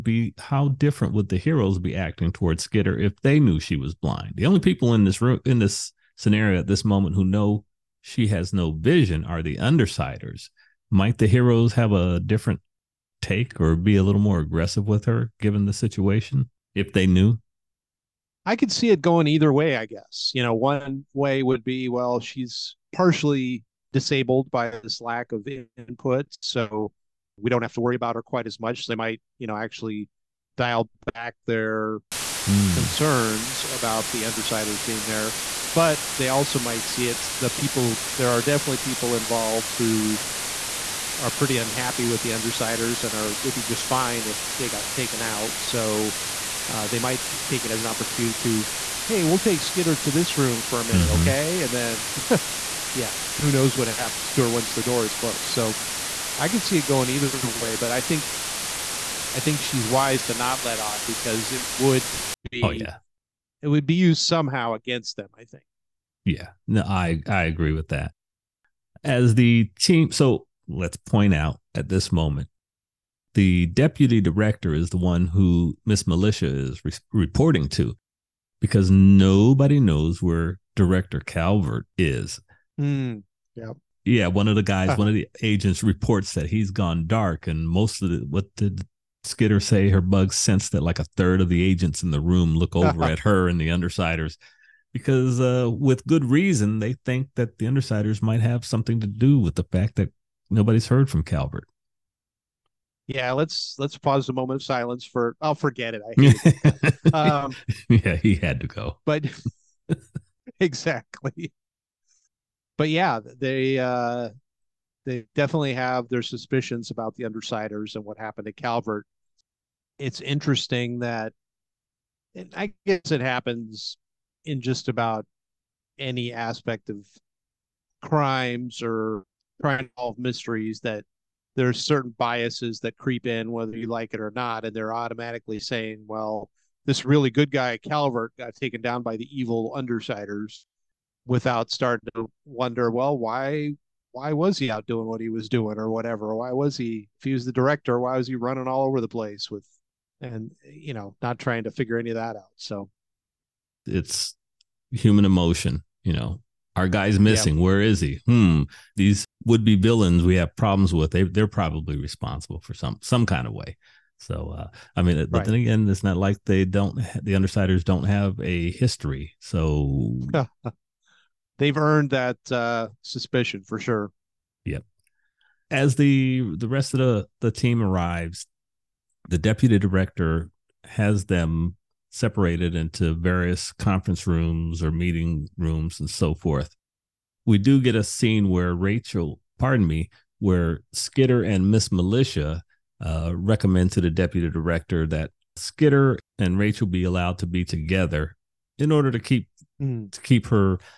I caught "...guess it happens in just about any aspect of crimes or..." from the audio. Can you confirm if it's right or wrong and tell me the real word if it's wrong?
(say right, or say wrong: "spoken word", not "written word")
right.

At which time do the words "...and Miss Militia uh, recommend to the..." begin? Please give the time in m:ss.
3:11.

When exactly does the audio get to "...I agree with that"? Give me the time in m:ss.
1:07.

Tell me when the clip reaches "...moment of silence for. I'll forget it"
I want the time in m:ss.
1:44.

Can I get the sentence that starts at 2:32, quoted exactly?
So it's human emotion, you know.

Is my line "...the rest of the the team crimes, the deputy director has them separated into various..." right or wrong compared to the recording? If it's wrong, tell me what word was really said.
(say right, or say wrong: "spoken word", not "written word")
wrong: "arrives", not "crimes".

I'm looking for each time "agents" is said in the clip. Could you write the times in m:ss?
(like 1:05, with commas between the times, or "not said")
1:25, 1:31.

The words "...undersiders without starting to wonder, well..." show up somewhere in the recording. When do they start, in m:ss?
2:19.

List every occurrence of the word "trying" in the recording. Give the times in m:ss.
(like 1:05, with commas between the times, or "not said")
2:09, 2:31.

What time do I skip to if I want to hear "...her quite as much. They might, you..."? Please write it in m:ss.
0:28.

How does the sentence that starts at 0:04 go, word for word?
The only people in this room in this scenario at this moment who know she has no vision are the undersiders.